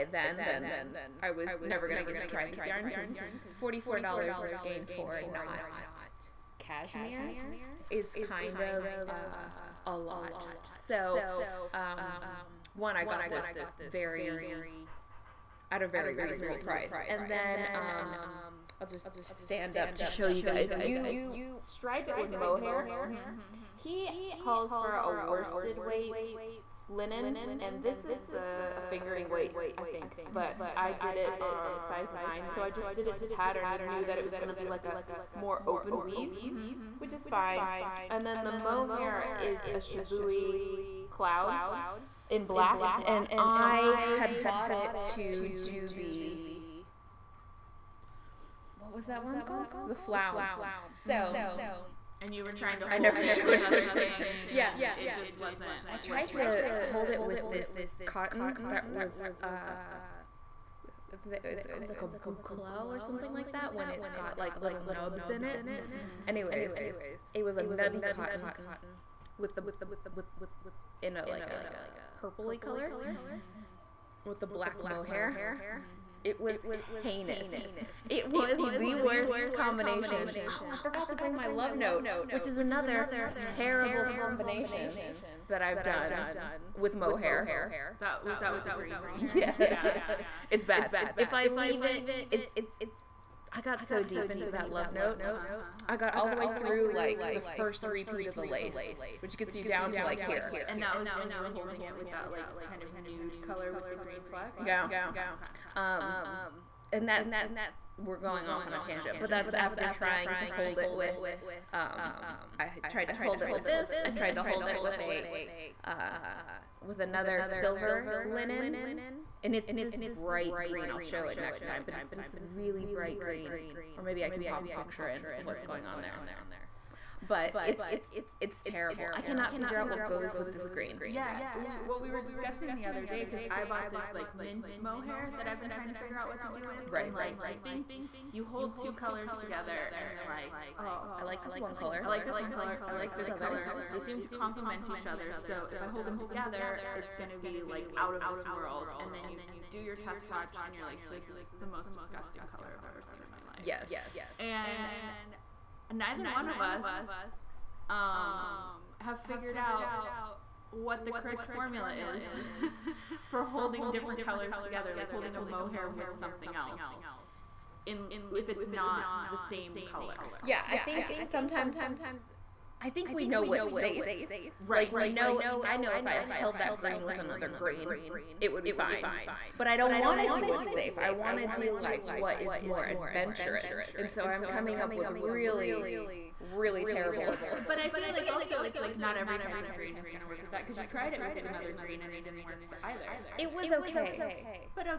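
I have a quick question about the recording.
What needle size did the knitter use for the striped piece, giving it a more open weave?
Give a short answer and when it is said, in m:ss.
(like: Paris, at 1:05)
9, at 0:31.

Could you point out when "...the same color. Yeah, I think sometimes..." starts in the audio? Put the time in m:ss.
2:49.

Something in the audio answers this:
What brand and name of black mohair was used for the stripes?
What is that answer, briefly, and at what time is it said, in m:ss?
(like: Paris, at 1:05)
Shibui Cloud, at 0:39.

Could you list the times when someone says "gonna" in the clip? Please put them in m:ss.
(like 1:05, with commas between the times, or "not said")
0:01, 0:34.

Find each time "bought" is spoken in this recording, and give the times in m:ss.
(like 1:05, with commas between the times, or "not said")
0:44, 2:13.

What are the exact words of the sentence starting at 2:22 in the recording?
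I, I like, this, this color.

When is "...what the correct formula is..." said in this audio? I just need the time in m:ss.
2:40.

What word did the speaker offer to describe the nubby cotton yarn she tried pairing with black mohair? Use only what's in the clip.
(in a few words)
boucle.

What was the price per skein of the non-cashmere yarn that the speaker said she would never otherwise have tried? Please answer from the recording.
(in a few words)
$44.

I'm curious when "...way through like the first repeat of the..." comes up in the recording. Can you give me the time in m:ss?
1:36.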